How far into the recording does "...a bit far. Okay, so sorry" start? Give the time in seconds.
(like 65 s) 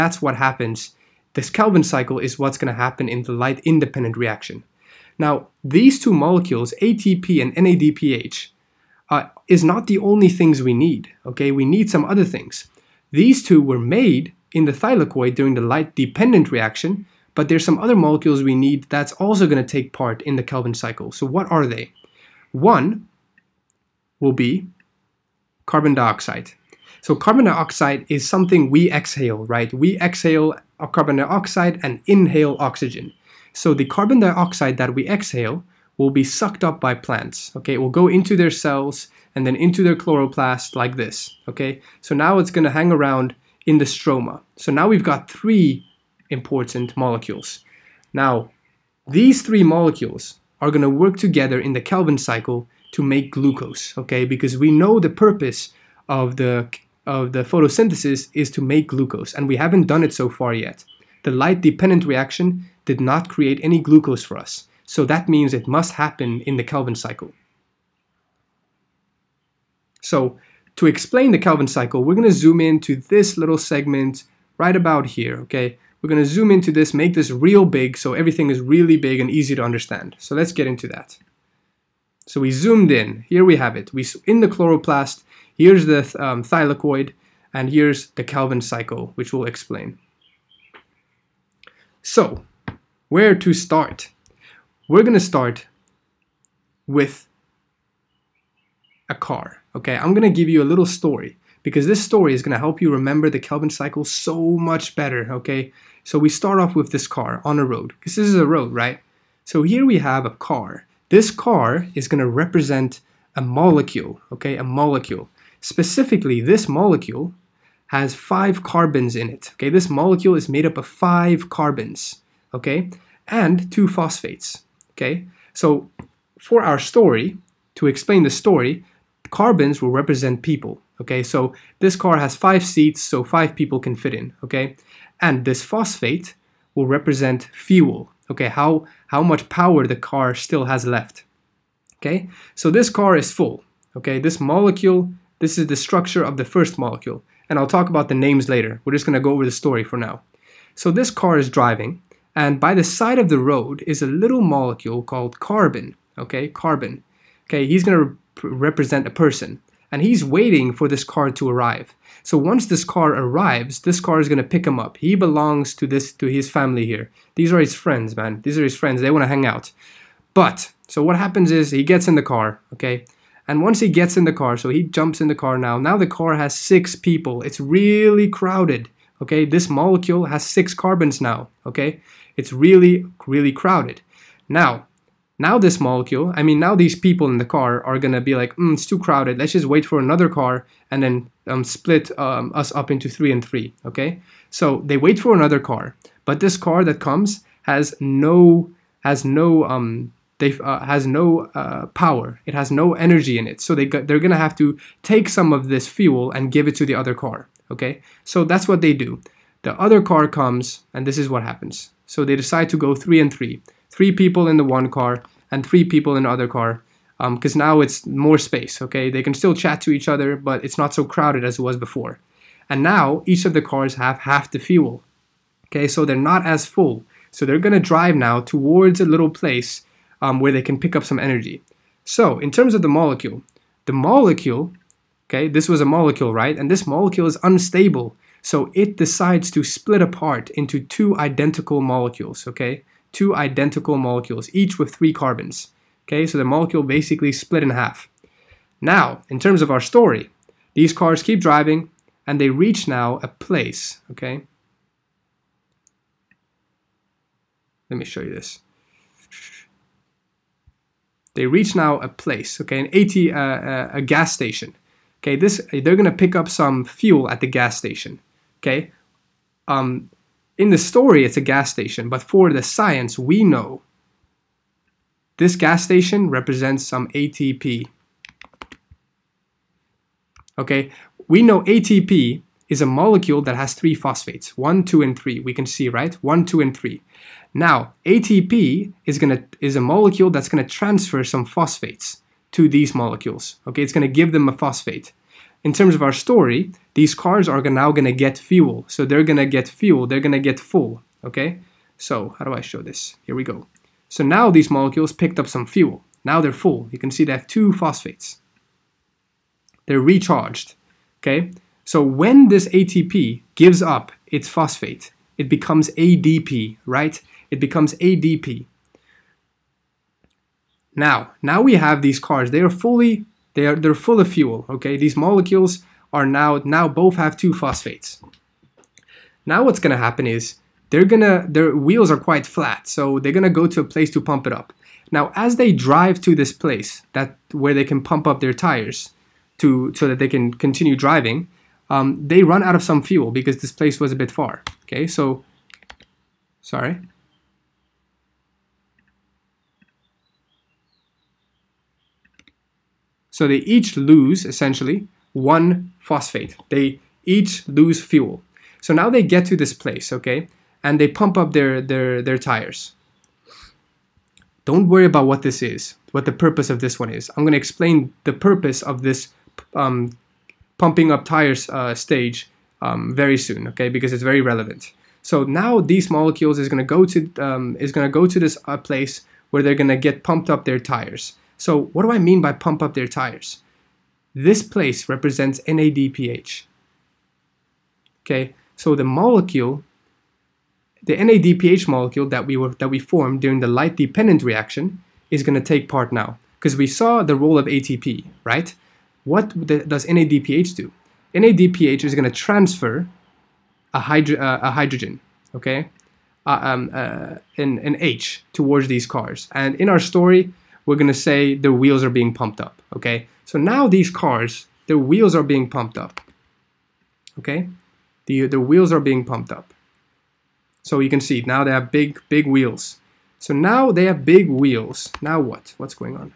344 s.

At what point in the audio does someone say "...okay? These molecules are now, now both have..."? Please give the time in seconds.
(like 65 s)
324 s.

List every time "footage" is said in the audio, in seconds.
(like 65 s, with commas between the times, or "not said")
not said.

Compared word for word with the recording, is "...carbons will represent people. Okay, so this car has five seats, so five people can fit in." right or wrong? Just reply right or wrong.
right.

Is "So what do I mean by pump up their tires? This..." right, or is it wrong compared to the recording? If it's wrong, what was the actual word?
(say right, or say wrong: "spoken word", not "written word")
right.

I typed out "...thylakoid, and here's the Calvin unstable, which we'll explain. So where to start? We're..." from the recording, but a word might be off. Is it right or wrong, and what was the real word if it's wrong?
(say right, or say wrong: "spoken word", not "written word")
wrong: "cycle", not "unstable".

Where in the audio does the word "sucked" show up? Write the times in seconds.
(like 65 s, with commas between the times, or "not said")
36 s.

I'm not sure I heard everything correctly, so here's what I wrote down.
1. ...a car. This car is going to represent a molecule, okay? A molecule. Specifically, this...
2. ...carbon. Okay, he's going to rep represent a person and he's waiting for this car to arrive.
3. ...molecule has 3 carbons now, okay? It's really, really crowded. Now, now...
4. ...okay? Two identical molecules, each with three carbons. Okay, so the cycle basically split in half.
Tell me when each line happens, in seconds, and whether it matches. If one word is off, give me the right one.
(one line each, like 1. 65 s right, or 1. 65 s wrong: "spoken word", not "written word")
1. 110 s right
2. 156 s right
3. 179 s wrong: "6", not "3"
4. 242 s wrong: "molecule", not "cycle".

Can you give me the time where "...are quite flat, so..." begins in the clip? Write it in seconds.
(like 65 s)
332 s.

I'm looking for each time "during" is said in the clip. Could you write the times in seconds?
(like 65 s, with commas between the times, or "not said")
15 s, 393 s.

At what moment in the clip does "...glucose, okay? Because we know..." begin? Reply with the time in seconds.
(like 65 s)
53 s.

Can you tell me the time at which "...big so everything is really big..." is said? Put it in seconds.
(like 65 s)
77 s.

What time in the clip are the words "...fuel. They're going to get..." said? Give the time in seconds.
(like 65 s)
299 s.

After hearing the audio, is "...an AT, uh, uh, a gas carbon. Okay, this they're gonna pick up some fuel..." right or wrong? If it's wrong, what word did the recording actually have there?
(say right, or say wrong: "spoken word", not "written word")
wrong: "station", not "carbon".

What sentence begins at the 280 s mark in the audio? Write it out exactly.
Okay, we know ATP is a molecule that has three phosphates, one, two, and three.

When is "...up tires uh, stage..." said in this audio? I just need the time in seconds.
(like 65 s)
371 s.